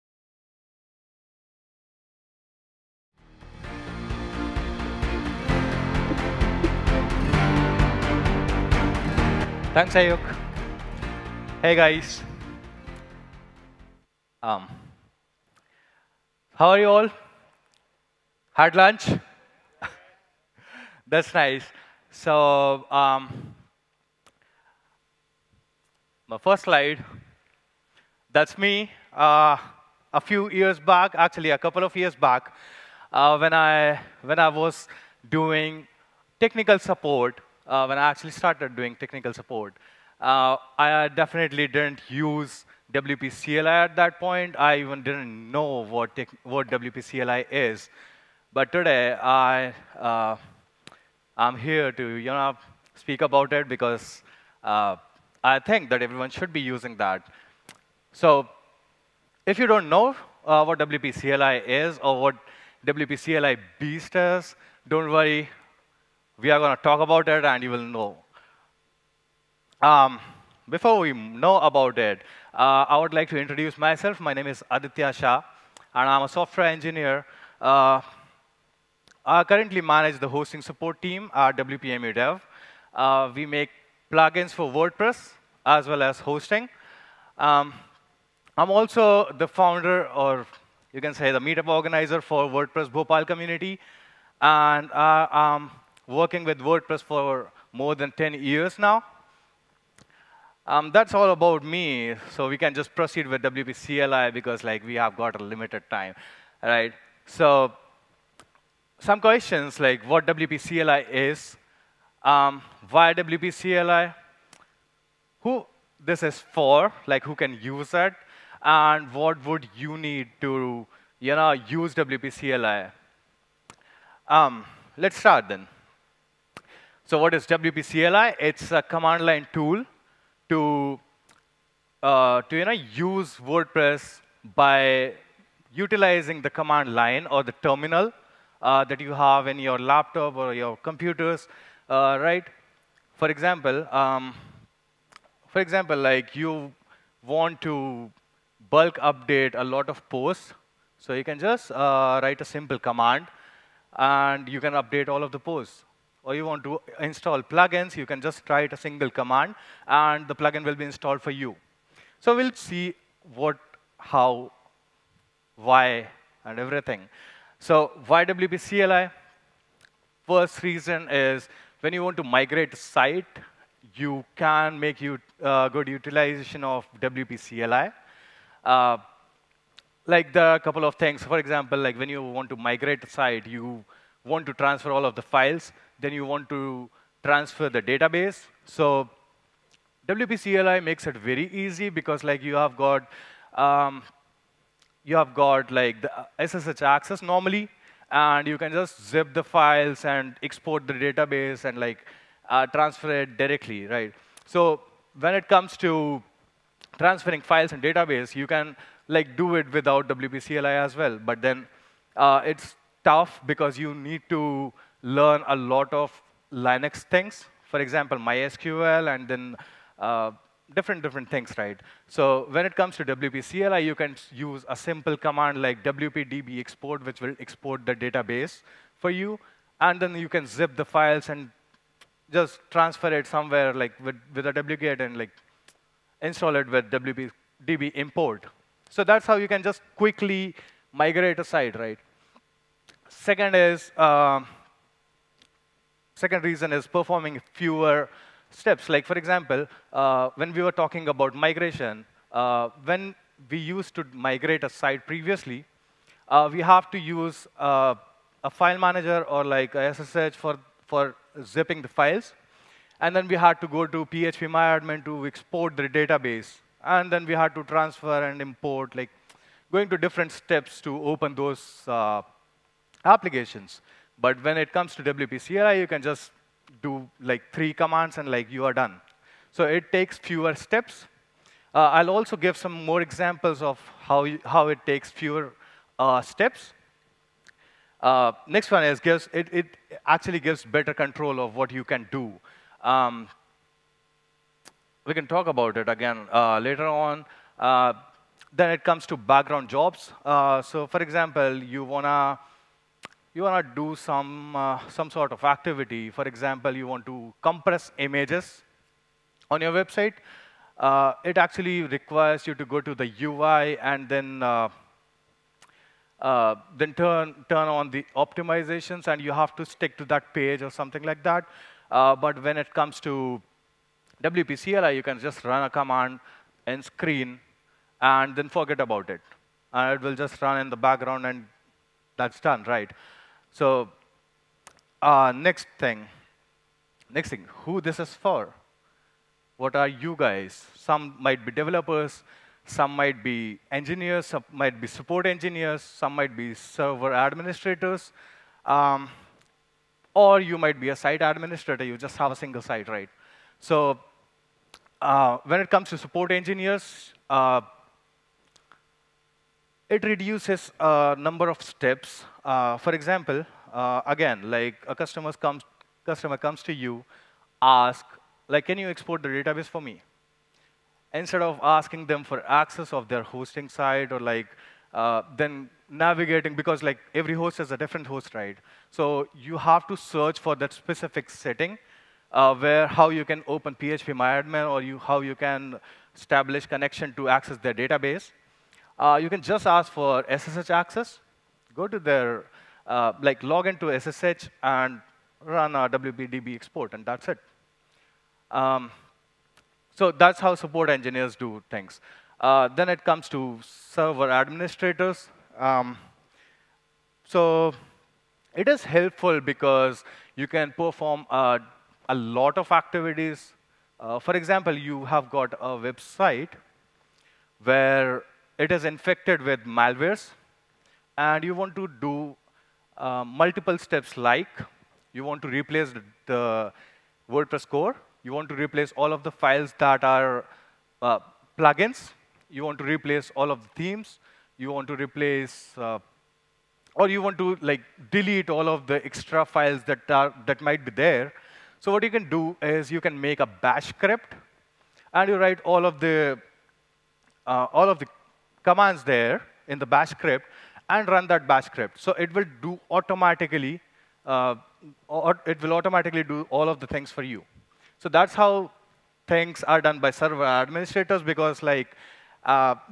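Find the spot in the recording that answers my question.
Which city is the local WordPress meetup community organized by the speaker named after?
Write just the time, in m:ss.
1:32.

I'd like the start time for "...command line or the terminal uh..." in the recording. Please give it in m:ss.
2:16.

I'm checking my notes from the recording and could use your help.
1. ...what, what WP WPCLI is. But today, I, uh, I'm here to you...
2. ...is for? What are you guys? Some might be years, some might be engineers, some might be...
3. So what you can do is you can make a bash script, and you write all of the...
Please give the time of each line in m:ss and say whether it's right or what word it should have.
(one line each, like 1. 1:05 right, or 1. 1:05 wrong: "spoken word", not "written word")
1. 0:45 wrong: "CLI", not "WPCLI"
2. 5:37 wrong: "developers", not "years"
3. 7:21 right.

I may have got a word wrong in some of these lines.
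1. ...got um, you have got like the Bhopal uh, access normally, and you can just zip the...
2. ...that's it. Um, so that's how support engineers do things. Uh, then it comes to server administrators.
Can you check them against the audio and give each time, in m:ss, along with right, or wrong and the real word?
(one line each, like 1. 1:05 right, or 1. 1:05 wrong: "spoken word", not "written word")
1. 3:12 wrong: "SSH", not "Bhopal"
2. 6:37 right.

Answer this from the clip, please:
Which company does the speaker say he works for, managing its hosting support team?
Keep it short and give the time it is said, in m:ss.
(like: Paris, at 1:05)
WP Dev, at 1:21.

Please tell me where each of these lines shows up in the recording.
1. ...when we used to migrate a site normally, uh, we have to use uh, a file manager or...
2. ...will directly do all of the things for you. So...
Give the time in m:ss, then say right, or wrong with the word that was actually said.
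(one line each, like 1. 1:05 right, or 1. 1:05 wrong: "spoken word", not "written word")
1. 4:12 wrong: "previously", not "normally"
2. 7:35 wrong: "automatically", not "directly".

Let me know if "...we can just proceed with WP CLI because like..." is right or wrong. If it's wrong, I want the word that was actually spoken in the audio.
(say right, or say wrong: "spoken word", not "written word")
right.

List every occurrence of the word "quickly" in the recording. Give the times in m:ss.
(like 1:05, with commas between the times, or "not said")
3:59.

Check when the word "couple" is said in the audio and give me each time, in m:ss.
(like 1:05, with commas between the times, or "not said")
0:31, 3:00.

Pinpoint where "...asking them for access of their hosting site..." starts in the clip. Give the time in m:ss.
6:11.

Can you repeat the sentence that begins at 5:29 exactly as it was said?
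And it will just run in the background and that's done, right?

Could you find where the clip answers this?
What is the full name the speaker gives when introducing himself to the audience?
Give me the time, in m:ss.
1:14.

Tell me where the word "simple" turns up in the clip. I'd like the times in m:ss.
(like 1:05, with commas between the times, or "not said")
2:32, 3:44.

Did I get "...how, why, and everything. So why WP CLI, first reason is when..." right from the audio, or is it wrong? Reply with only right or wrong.
right.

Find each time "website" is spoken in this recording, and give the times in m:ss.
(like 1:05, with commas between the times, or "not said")
5:09, 6:55.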